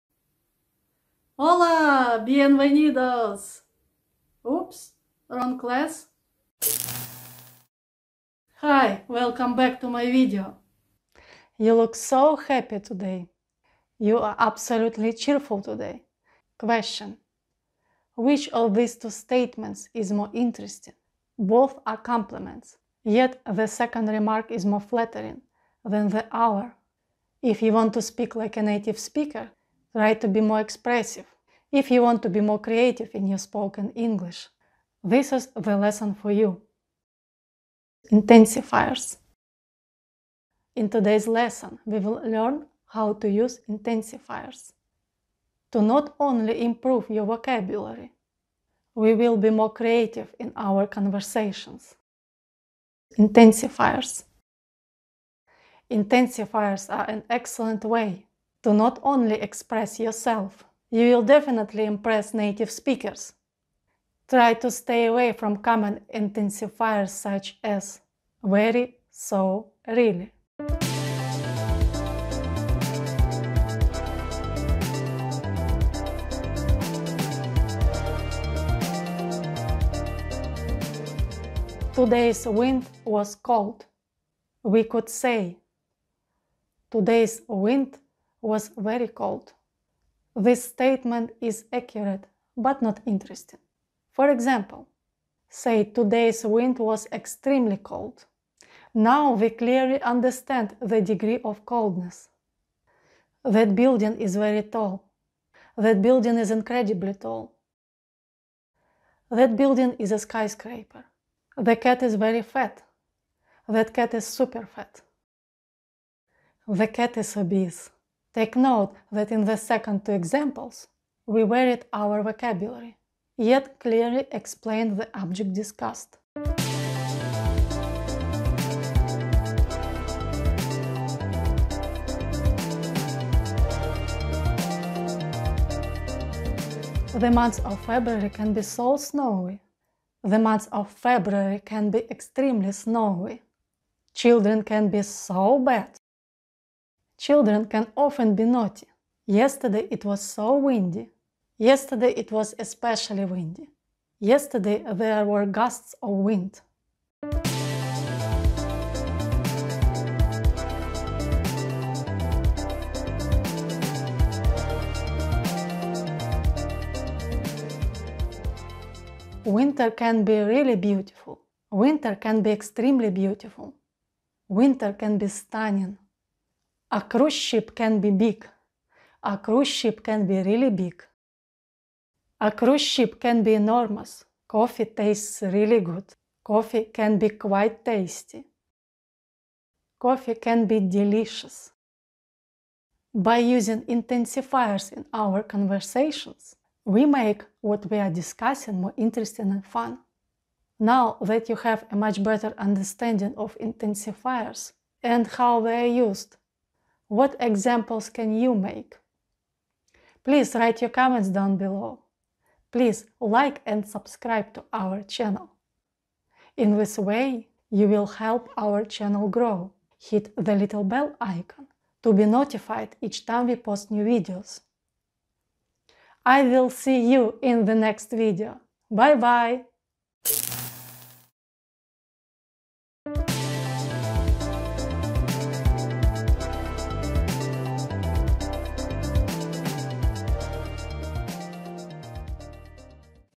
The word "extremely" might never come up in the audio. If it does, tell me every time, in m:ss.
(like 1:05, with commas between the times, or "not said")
1:37, 2:22, 2:52.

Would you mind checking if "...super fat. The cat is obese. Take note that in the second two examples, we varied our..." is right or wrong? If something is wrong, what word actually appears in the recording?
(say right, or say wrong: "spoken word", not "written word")
right.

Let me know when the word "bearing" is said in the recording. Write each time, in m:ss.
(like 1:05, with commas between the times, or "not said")
not said.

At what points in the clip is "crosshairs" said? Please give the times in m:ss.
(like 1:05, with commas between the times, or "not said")
not said.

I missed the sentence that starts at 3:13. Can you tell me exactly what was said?
By using intensifiers in our conversations, we make what we are discussing more interesting and fun.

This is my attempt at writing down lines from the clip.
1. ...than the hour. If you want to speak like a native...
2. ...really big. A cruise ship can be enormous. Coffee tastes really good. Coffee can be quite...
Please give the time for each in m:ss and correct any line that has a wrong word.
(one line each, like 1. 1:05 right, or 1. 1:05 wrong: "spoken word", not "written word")
1. 0:25 right
2. 3:00 right.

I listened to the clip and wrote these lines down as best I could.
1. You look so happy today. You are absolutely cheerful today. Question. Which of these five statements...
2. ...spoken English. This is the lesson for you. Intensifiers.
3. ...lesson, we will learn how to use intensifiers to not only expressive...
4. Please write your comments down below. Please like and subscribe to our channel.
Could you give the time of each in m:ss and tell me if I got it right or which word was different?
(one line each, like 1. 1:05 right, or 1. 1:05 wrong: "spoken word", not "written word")
1. 0:11 wrong: "two", not "five"
2. 0:33 right
3. 0:41 wrong: "improve", not "expressive"
4. 3:30 right.